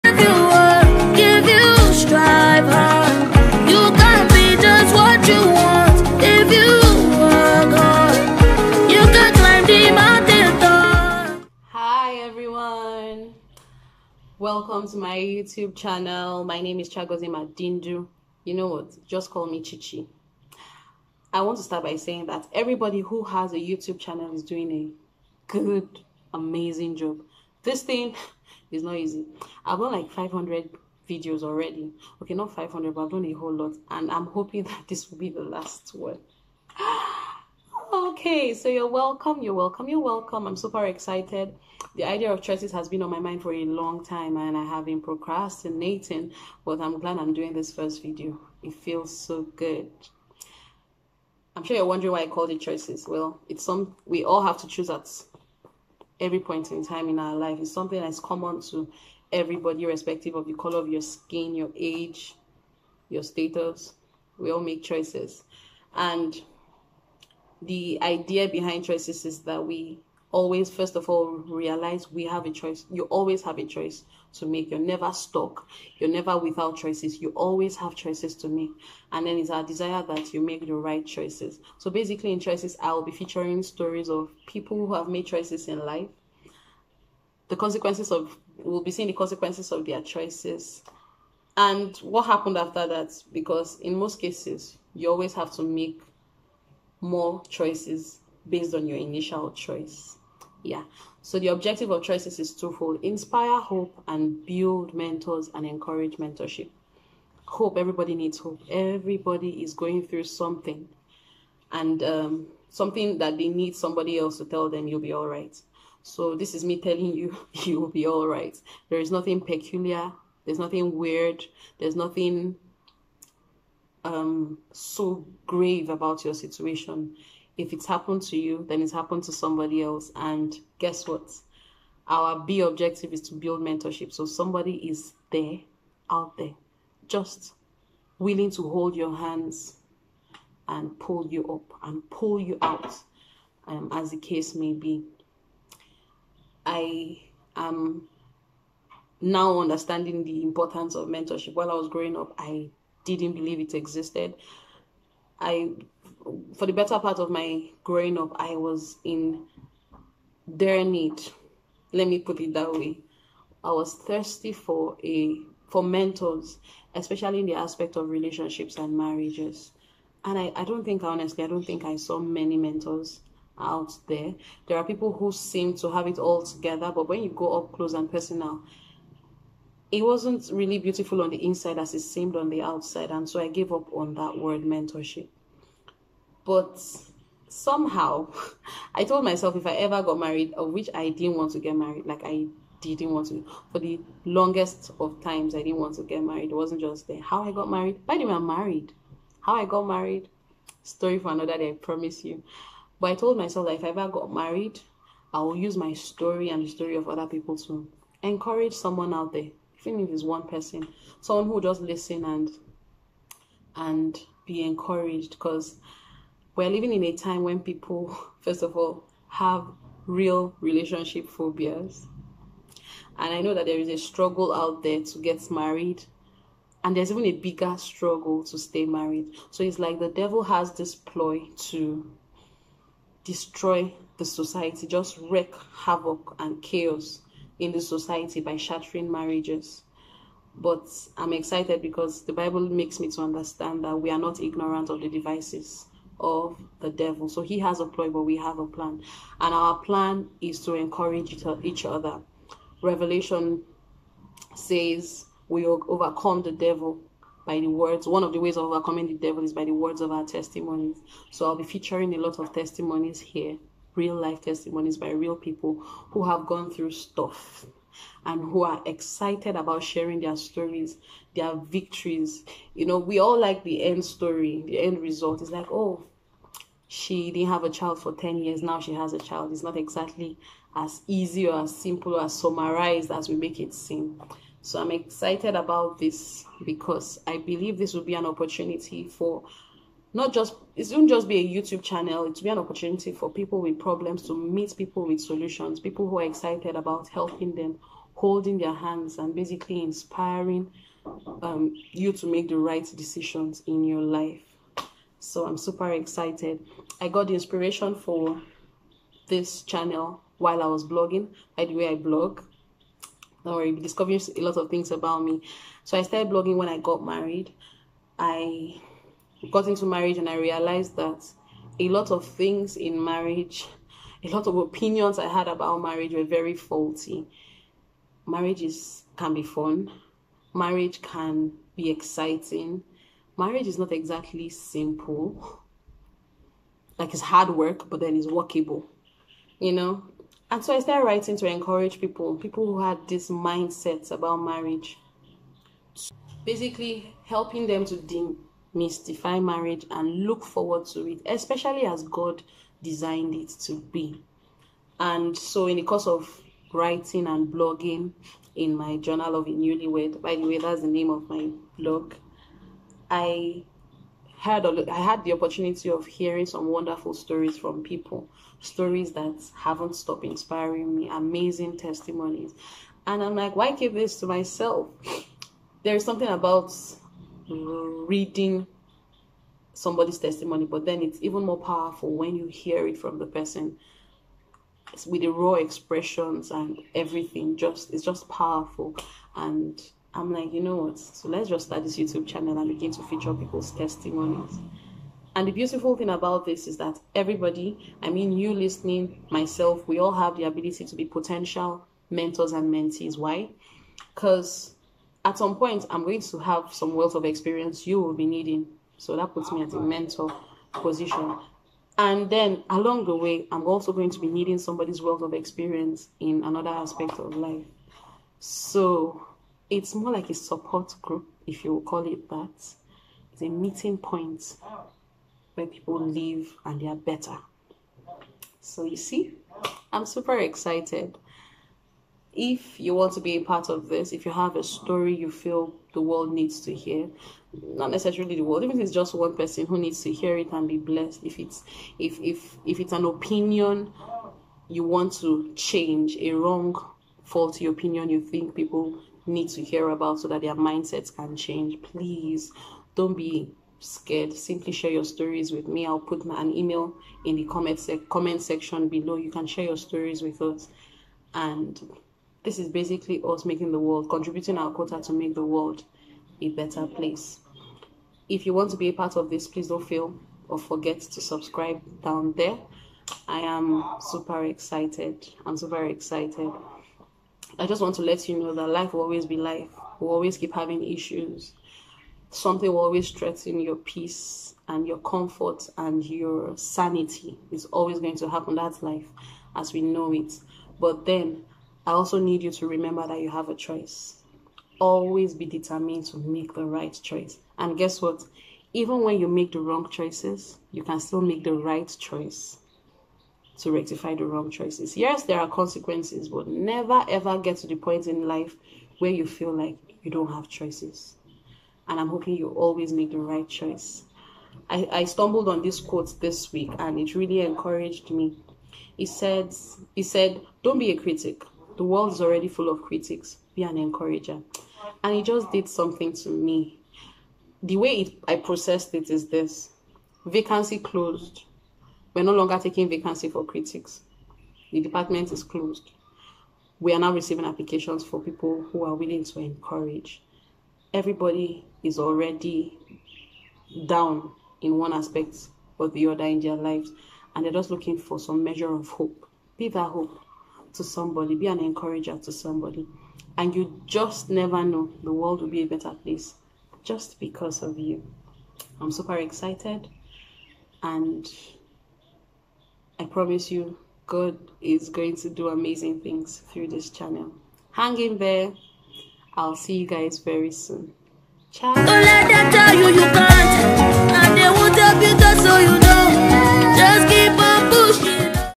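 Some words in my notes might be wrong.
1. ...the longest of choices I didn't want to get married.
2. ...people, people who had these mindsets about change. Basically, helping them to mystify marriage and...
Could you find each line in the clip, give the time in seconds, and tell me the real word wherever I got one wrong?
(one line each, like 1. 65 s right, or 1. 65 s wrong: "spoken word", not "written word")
1. 193 s wrong: "times", not "choices"
2. 341 s wrong: "marriage", not "change".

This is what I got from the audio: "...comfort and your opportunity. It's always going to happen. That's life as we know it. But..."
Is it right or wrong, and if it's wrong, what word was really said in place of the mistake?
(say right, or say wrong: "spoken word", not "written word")
wrong: "sanity", not "opportunity".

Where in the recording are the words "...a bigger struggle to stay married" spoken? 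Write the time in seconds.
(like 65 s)
227 s.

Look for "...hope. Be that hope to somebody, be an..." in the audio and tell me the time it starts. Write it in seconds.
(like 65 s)
548 s.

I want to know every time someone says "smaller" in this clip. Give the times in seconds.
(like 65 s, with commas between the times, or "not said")
not said.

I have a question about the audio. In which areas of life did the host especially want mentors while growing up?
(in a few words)
Relationships and marriages.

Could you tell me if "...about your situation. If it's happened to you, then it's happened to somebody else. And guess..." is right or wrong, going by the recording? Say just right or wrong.
right.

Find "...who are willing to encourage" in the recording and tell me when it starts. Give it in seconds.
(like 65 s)
538 s.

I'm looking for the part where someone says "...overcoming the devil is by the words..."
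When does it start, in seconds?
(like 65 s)
258 s.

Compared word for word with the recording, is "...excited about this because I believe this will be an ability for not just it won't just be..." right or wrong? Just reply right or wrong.
wrong.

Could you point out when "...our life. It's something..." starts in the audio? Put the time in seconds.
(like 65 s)
57 s.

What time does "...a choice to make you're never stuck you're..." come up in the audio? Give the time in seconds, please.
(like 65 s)
73 s.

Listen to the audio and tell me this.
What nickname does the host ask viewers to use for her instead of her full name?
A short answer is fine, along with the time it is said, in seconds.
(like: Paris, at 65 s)
Chichi, at 19 s.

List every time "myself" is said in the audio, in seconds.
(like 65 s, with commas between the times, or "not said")
189 s, 203 s, 374 s, 399 s.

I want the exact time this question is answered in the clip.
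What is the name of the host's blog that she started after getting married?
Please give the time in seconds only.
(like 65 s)
358 s.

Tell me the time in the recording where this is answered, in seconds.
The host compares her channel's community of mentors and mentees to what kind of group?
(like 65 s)
420 s.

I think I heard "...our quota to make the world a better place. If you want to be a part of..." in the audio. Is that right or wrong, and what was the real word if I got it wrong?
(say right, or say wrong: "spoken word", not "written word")
right.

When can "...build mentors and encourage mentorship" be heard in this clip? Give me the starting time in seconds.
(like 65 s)
104 s.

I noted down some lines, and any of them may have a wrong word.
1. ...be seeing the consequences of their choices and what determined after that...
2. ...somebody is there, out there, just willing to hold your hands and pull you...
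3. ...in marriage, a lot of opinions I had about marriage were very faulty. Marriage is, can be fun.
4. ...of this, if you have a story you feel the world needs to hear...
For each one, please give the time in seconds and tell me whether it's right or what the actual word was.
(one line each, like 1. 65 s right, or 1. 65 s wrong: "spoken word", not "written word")
1. 88 s wrong: "happened", not "determined"
2. 134 s right
3. 322 s right
4. 433 s right.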